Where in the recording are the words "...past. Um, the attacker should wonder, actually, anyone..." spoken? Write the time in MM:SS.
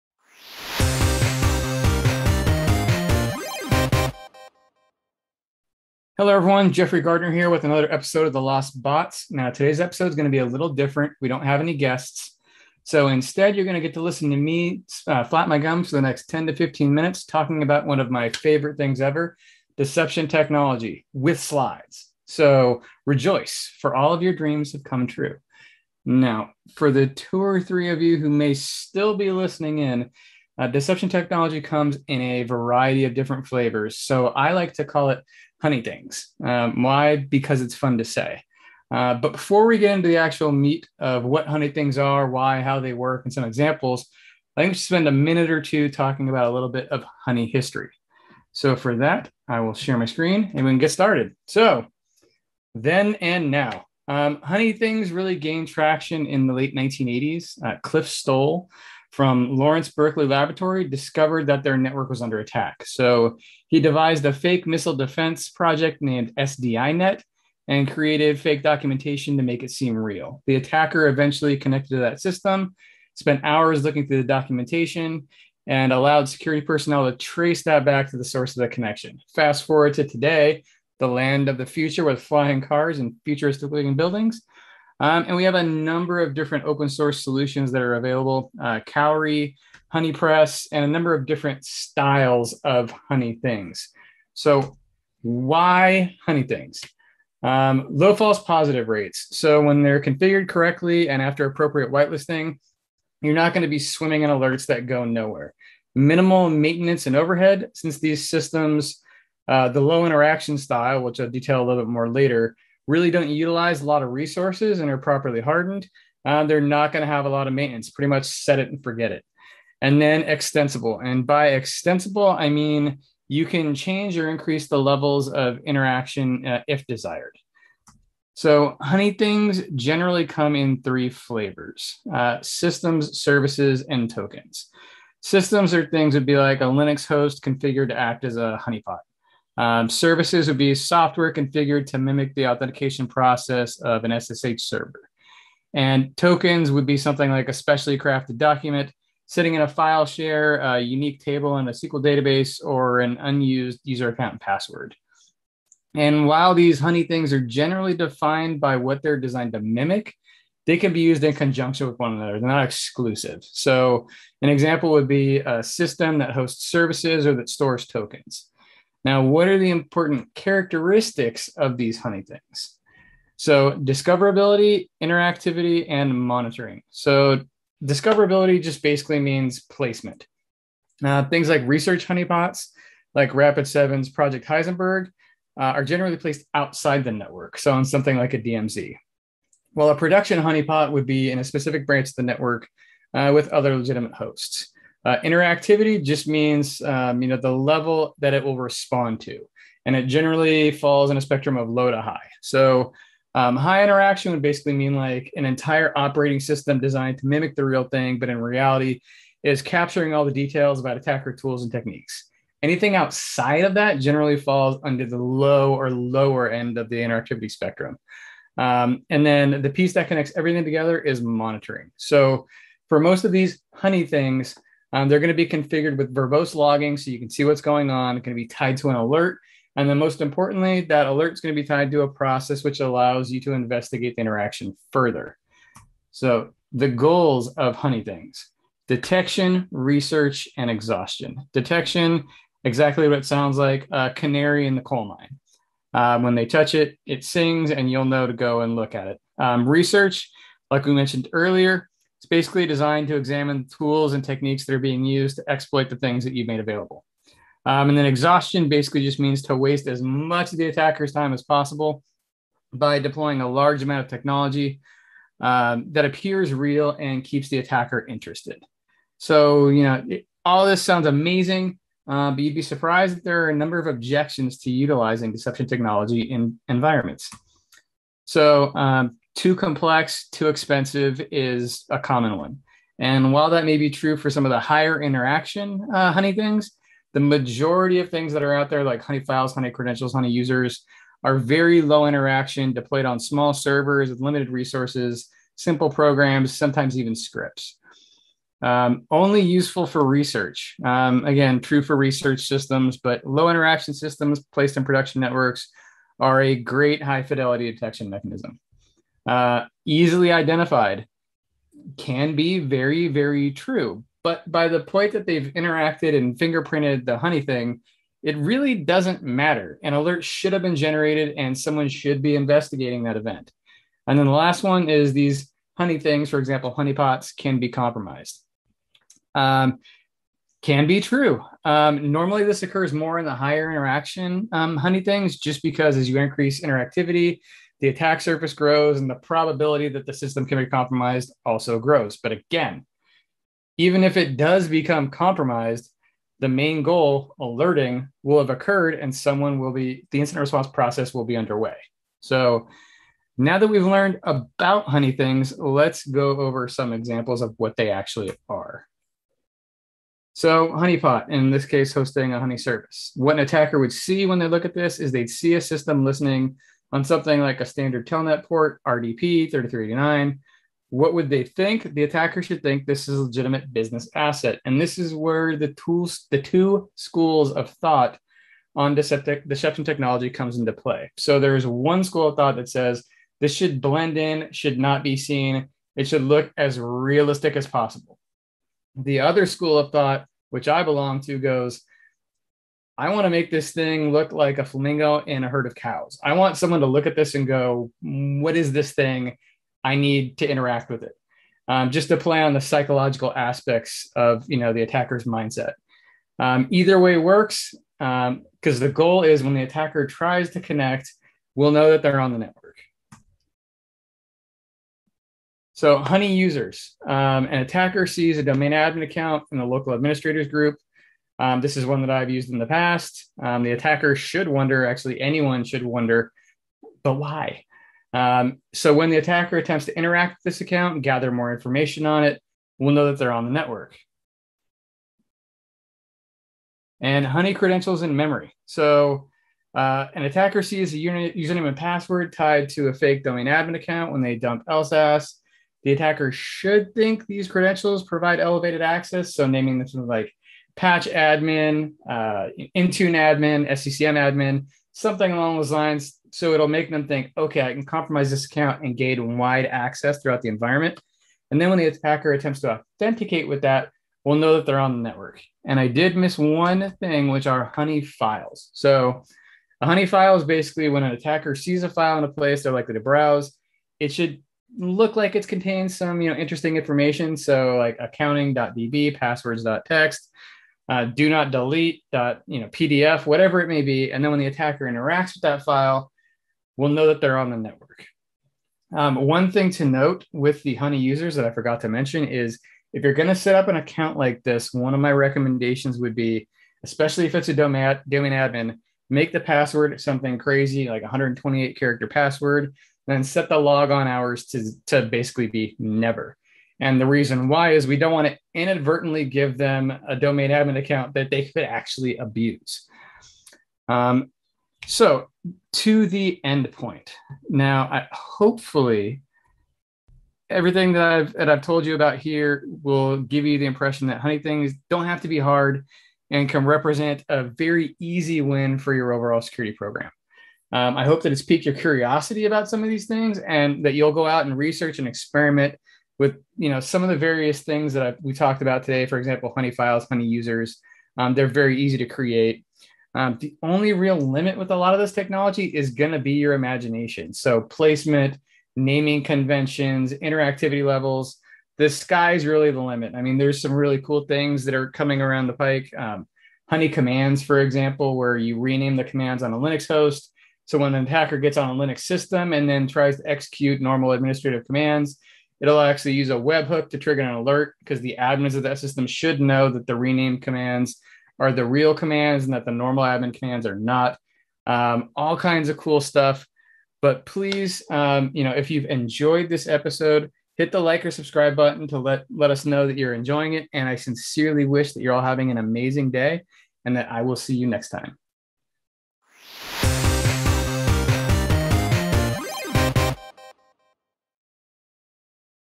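07:02.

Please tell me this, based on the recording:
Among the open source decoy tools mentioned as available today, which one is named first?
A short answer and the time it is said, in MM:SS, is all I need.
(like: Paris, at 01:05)
Cowrie, at 01:28.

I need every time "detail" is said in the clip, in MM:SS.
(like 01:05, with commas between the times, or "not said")
01:51, 03:30.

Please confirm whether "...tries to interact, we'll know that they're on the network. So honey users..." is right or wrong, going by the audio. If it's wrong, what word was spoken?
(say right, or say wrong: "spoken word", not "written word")
wrong: "connect", not "interact".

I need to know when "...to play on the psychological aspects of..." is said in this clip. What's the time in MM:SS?
06:42.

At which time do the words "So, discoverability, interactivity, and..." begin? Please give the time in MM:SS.
02:53.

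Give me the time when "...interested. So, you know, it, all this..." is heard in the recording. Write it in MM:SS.
04:28.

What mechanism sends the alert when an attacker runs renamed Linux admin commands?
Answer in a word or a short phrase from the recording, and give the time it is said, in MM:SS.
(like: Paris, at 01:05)
Webhook, at 09:26.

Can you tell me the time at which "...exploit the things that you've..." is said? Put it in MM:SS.
04:15.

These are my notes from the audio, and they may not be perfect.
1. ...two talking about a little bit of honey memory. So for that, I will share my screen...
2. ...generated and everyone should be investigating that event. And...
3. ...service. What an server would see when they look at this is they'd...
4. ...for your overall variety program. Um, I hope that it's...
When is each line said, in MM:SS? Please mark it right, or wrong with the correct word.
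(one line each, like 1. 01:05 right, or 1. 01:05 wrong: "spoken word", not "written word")
1. 00:45 wrong: "history", not "memory"
2. 05:20 wrong: "someone", not "everyone"
3. 06:02 wrong: "attacker", not "server"
4. 08:48 wrong: "security", not "variety".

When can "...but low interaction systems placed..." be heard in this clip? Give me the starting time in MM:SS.
05:02.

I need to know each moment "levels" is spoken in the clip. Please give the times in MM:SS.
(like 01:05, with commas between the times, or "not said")
02:04, 03:17, 09:10.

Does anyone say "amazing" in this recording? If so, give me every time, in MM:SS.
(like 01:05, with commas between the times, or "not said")
04:31, 09:45.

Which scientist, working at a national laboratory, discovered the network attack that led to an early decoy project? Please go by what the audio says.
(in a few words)
Cliff Stoll.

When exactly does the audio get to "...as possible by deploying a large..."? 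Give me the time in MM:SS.
04:21.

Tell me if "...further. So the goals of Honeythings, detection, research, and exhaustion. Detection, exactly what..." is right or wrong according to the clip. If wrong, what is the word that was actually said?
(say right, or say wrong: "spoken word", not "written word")
right.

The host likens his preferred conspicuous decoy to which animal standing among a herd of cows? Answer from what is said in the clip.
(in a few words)
Flamingo.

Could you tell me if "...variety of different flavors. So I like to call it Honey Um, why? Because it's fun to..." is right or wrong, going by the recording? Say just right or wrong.
right.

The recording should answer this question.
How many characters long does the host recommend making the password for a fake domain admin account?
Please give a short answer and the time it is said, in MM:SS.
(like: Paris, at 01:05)
128, at 08:21.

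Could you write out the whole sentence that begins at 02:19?
Um, services would be software configured to mimic the authentication process of an SSH server.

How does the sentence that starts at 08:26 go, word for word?
And the reason why is we don't want to inadvertently give them a domain admin account that they could actually abuse.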